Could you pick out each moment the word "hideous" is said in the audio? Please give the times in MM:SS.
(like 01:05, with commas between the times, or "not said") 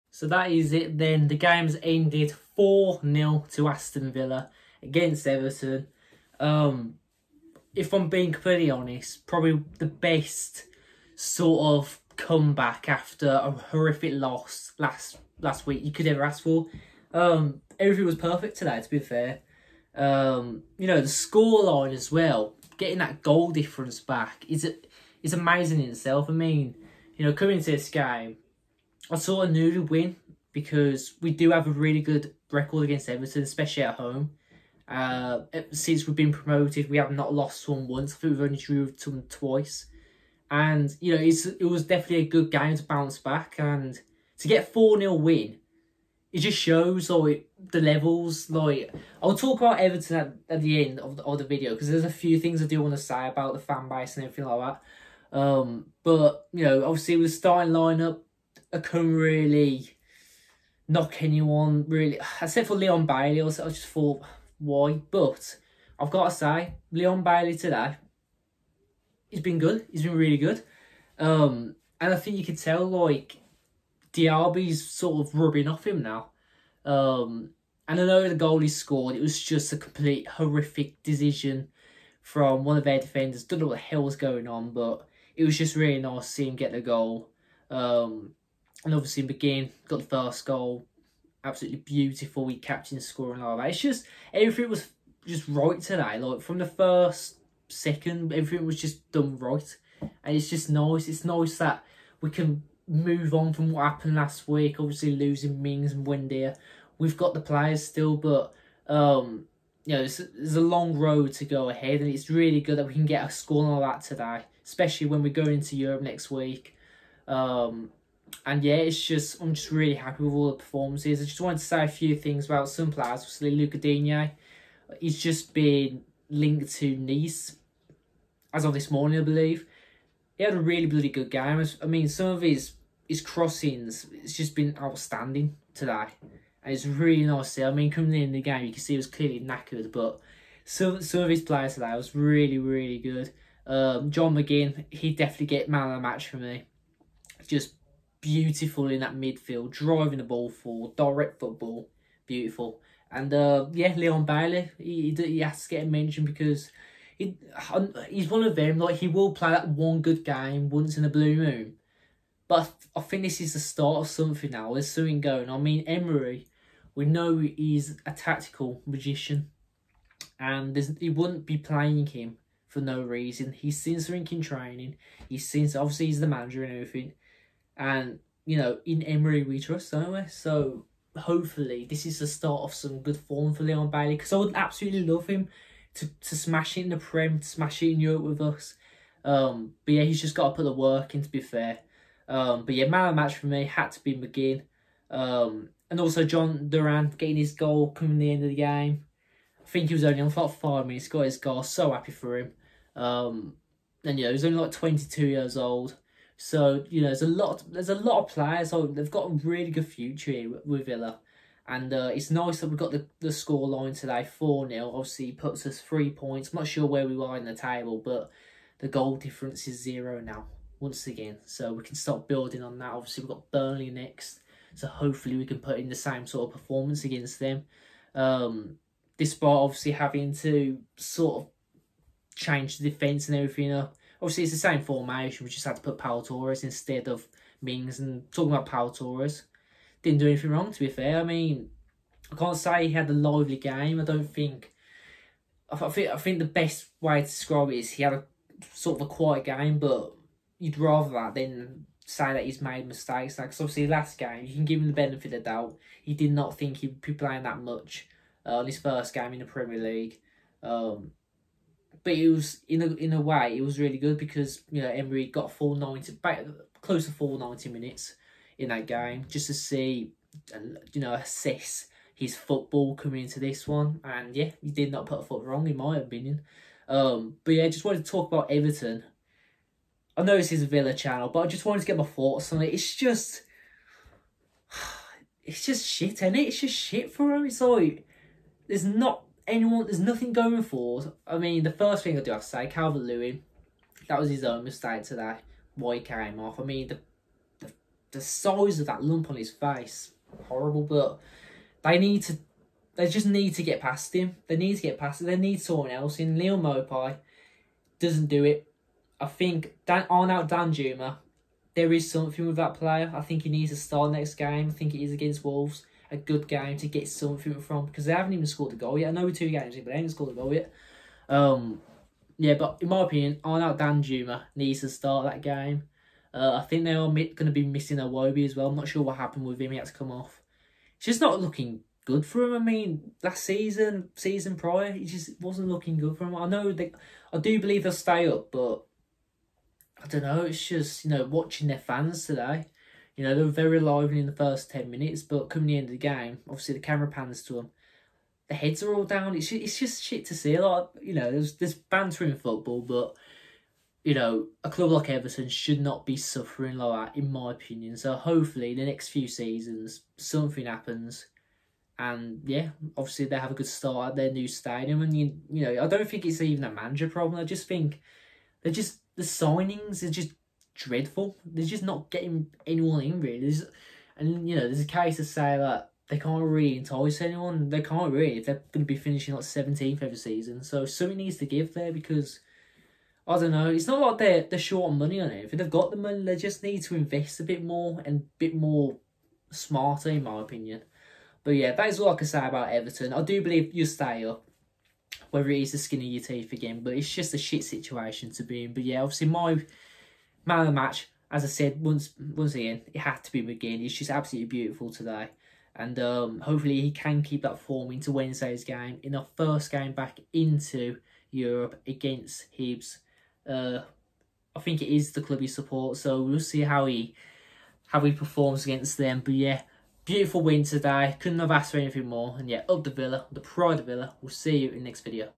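not said.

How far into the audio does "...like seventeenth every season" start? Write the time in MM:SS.
06:19.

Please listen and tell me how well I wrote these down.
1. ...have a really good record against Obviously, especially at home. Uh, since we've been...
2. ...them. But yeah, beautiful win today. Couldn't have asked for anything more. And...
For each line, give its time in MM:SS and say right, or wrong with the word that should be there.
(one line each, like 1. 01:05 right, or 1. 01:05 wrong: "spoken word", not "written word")
1. 00:31 wrong: "Everton", not "Obviously"
2. 06:58 right.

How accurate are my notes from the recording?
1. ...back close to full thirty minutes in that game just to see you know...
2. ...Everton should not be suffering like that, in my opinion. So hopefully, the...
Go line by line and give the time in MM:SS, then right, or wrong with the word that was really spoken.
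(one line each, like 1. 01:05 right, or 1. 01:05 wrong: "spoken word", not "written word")
1. 04:26 wrong: "ninety", not "thirty"
2. 05:55 right.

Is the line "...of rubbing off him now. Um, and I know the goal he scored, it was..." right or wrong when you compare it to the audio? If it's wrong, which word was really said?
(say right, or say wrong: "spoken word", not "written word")
right.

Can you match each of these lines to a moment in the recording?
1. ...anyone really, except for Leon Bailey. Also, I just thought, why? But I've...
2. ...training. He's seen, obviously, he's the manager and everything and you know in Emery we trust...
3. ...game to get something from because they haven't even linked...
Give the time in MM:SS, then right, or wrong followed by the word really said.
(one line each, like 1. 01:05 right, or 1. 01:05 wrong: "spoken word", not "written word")
1. 01:01 right
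2. 02:54 right
3. 05:16 wrong: "scored", not "linked".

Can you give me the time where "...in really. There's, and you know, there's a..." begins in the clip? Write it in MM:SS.
06:13.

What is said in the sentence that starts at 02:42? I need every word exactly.
But I think this is the start of something now.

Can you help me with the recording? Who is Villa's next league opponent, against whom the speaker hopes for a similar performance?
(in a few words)
Burnley.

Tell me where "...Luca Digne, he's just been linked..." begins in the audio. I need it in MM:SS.
02:03.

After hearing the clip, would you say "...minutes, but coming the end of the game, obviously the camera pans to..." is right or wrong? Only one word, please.
right.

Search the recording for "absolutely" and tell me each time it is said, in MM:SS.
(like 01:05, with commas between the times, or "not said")
01:31, 03:04, 06:44.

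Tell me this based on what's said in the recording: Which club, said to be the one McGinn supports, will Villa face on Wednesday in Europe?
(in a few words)
Hibs.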